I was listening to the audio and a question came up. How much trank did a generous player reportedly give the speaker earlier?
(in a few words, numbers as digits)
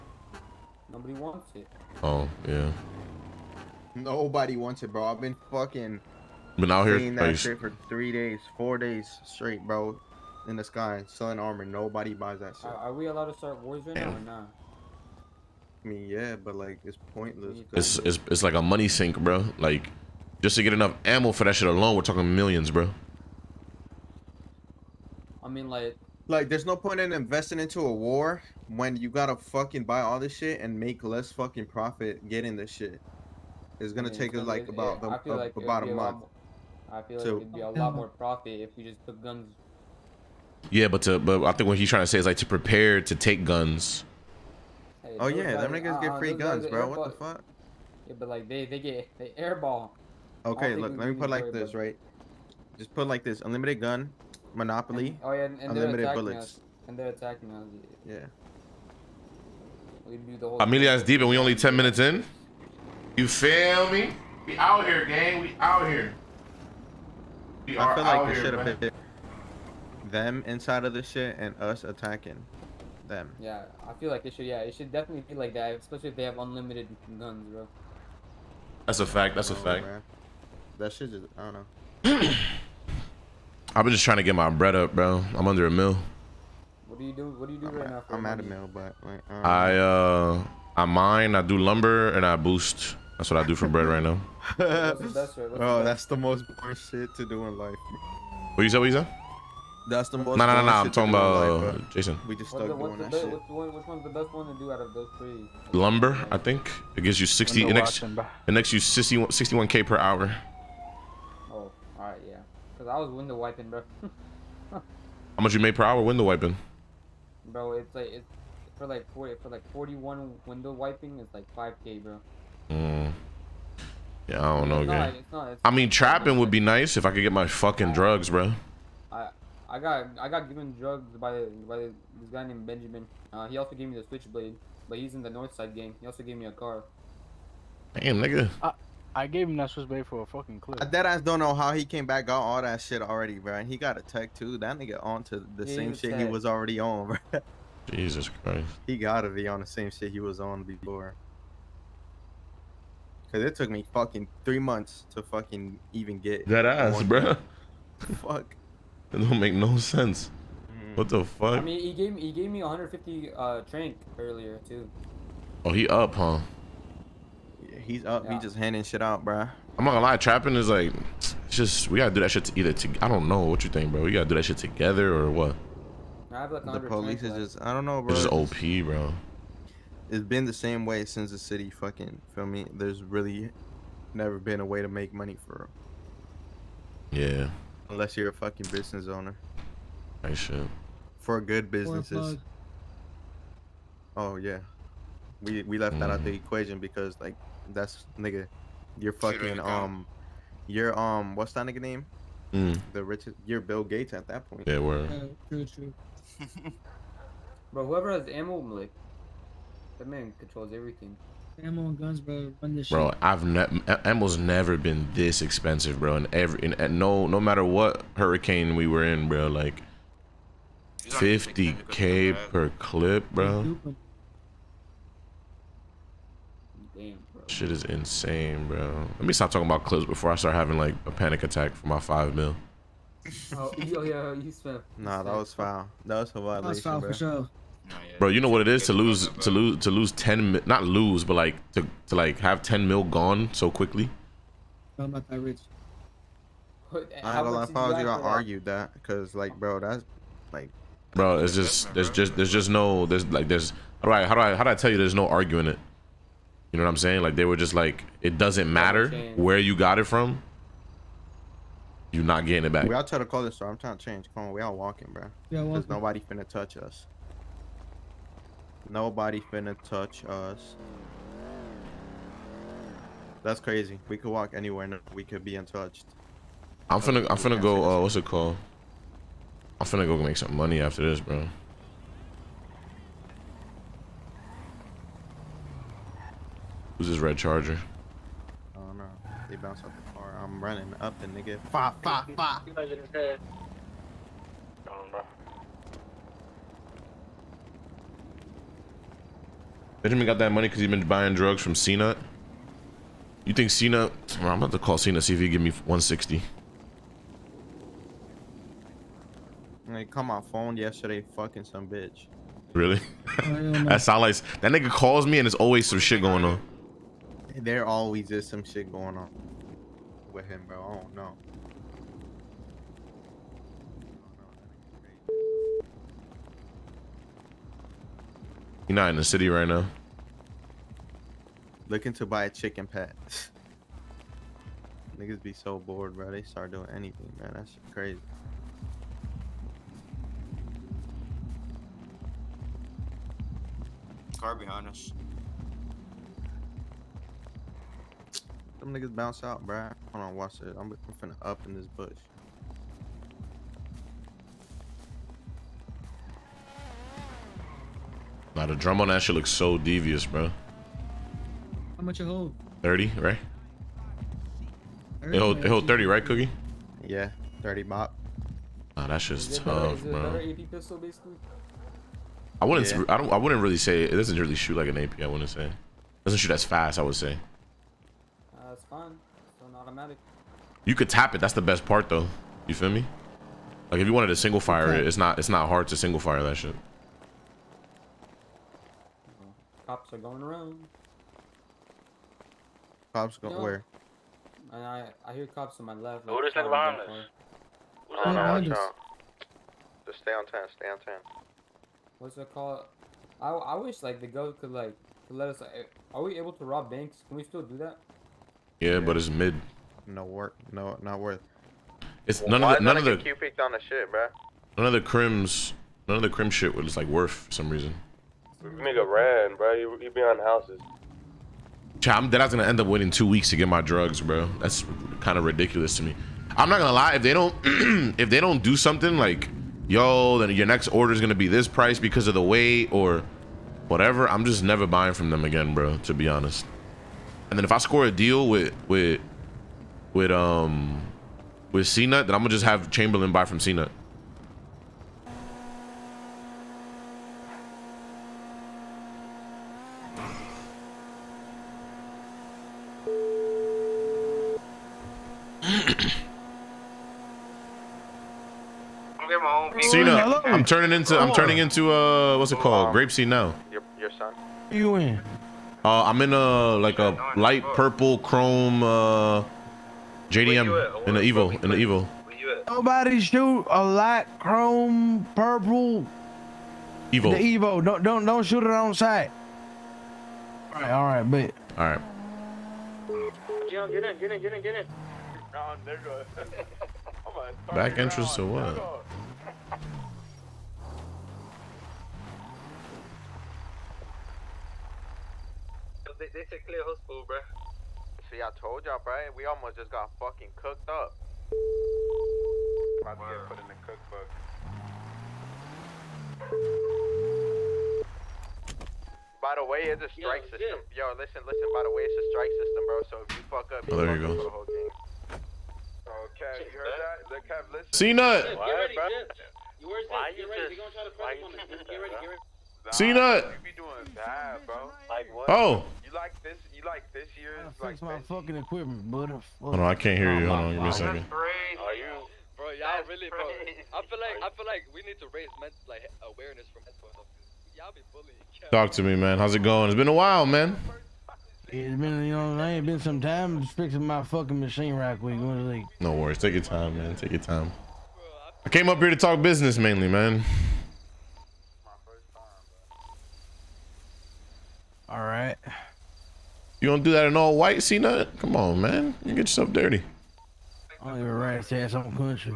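150.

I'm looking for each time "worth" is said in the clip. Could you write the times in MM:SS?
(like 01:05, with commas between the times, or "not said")
06:51, 06:57.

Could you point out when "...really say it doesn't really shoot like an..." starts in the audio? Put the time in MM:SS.
06:13.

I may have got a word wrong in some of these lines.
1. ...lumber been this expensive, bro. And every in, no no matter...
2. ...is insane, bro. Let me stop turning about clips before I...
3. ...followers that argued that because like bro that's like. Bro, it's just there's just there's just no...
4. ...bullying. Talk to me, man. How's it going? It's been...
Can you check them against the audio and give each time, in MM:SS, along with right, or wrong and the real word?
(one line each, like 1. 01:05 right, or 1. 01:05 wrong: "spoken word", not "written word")
1. 03:34 wrong: "never", not "lumber"
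2. 03:47 wrong: "talking", not "turning"
3. 04:07 right
4. 08:58 right.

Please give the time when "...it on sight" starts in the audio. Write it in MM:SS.
07:58.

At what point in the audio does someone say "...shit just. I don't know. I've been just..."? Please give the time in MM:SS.
01:20.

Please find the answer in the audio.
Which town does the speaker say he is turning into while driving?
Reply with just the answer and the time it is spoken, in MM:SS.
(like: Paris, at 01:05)
Grapeseed, at 07:42.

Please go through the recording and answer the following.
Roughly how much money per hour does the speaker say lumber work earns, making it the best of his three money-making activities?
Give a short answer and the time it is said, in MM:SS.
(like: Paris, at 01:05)
61k, at 01:49.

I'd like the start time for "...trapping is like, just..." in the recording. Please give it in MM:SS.
02:50.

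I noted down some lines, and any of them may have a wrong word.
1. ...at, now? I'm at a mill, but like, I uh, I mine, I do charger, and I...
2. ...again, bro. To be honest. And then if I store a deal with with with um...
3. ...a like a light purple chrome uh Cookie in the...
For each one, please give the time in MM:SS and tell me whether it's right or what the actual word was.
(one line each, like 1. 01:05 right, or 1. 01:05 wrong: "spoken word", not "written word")
1. 01:27 wrong: "lumber", not "charger"
2. 07:15 wrong: "score", not "store"
3. 07:46 wrong: "JDM", not "Cookie".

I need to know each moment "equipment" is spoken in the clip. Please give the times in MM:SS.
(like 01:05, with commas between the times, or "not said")
08:48.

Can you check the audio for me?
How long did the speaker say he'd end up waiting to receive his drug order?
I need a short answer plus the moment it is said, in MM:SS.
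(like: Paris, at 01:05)
two weeks, at 07:03.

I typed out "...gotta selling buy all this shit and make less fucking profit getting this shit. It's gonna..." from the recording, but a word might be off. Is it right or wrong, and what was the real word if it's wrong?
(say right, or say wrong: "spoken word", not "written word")
wrong: "fucking", not "selling".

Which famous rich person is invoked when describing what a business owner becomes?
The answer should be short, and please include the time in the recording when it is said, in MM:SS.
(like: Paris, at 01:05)
Bill Gates, at 03:23.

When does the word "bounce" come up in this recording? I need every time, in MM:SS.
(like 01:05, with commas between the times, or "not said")
04:49, 05:49.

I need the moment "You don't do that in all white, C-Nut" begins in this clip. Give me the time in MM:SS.
09:16.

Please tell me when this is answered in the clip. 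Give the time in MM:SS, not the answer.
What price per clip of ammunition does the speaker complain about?
03:41.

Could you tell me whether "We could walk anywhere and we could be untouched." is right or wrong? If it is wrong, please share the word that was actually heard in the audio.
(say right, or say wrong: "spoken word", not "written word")
right.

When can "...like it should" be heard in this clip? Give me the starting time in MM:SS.
01:14.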